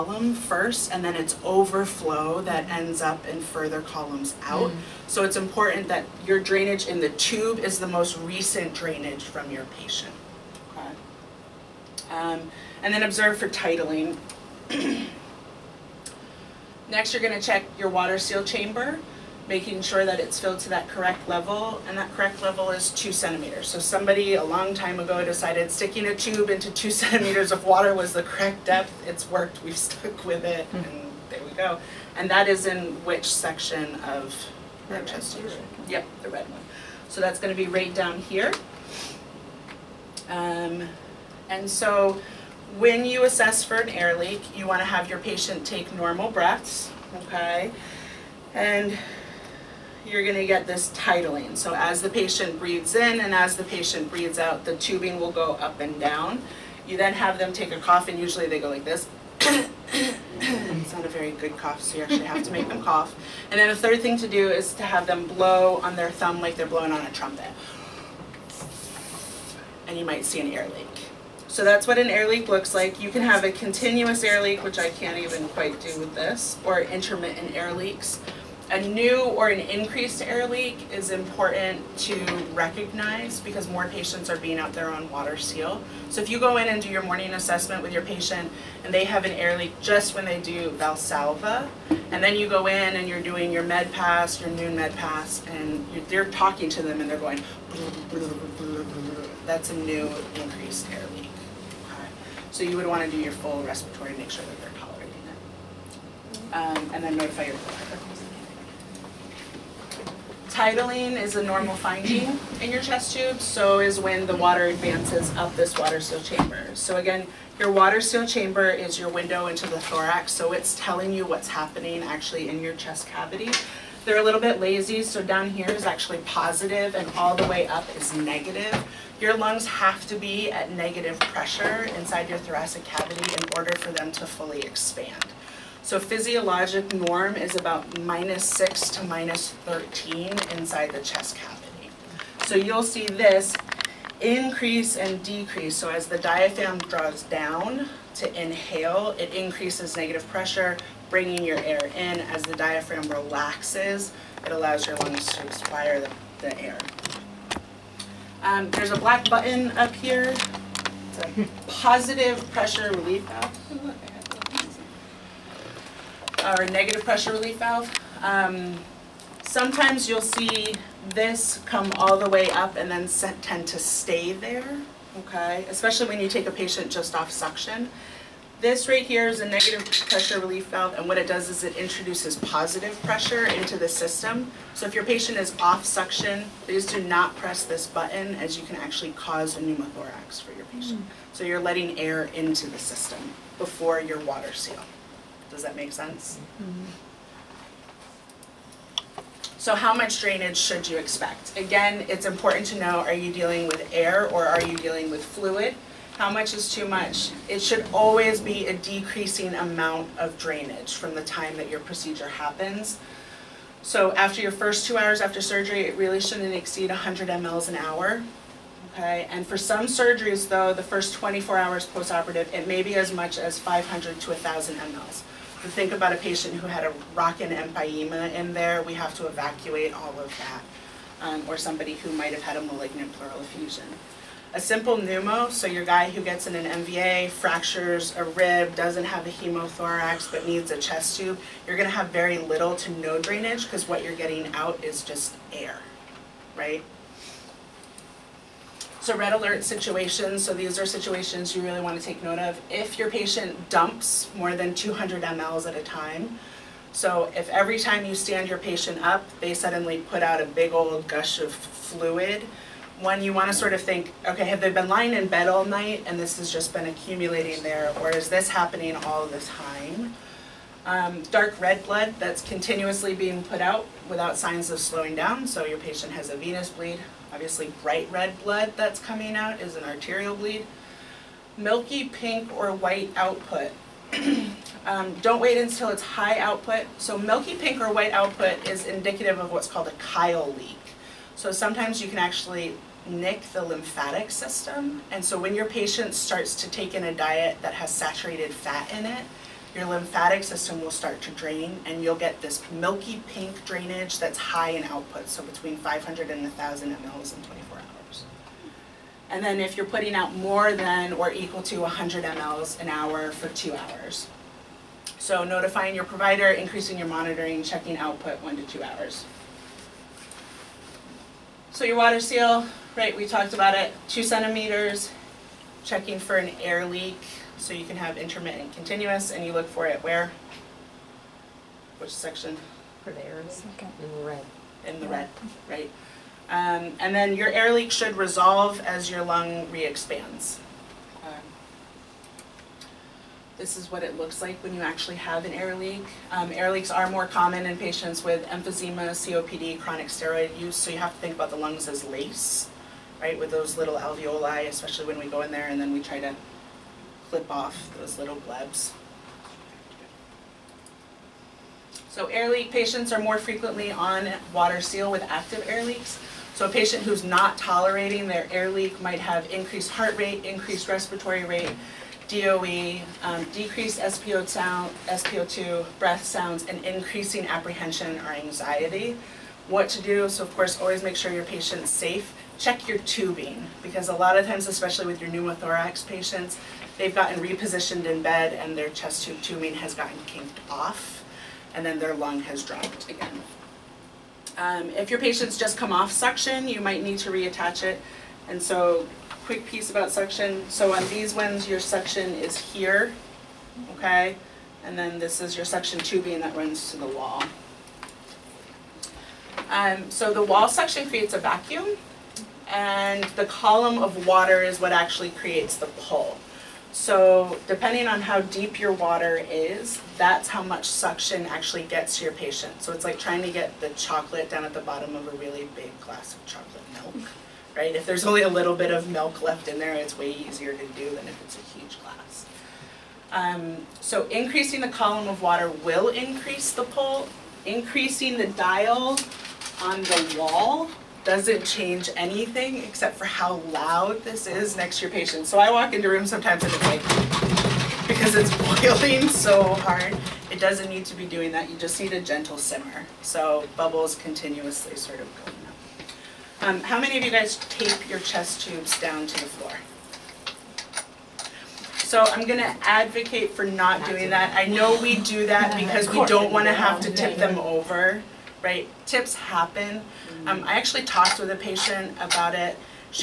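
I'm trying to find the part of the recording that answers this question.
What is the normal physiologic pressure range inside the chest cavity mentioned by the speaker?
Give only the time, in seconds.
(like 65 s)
138 s.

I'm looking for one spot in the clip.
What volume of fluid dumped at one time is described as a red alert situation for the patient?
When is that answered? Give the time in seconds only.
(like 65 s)
254 s.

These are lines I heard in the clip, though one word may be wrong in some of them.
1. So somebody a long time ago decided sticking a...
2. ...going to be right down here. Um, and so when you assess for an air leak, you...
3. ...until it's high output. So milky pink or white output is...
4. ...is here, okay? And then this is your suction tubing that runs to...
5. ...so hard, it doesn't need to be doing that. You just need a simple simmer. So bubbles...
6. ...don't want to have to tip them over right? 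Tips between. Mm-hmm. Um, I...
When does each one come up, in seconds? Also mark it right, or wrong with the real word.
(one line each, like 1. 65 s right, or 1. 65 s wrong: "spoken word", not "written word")
1. 23 s right
2. 37 s right
3. 285 s right
4. 402 s right
5. 449 s wrong: "gentle", not "simple"
6. 466 s wrong: "happen", not "between".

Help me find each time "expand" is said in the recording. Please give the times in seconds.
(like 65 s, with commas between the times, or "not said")
134 s, 339 s.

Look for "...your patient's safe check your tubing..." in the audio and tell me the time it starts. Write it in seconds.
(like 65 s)
381 s.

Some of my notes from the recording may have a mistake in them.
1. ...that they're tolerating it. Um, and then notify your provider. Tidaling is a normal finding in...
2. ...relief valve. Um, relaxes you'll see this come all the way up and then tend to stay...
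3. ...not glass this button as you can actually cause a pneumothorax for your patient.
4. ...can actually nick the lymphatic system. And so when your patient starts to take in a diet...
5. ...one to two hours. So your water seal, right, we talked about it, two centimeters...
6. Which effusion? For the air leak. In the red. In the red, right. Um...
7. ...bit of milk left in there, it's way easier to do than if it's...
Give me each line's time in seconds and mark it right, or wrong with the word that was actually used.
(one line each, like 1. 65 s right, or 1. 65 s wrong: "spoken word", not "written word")
1. 104 s right
2. 167 s wrong: "sometimes", not "relaxes"
3. 187 s wrong: "press", not "glass"
4. 292 s right
5. 318 s right
6. 331 s wrong: "section", not "effusion"
7. 428 s right.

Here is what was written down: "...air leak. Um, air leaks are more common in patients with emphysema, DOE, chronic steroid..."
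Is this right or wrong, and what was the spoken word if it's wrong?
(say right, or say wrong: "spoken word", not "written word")
wrong: "COPD", not "DOE".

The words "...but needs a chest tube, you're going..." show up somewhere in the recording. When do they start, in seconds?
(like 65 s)
240 s.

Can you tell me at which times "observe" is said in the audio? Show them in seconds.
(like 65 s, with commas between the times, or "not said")
13 s.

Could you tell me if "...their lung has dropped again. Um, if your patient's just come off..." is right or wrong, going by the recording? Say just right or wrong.
right.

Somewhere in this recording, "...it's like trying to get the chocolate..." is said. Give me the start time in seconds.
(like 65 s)
422 s.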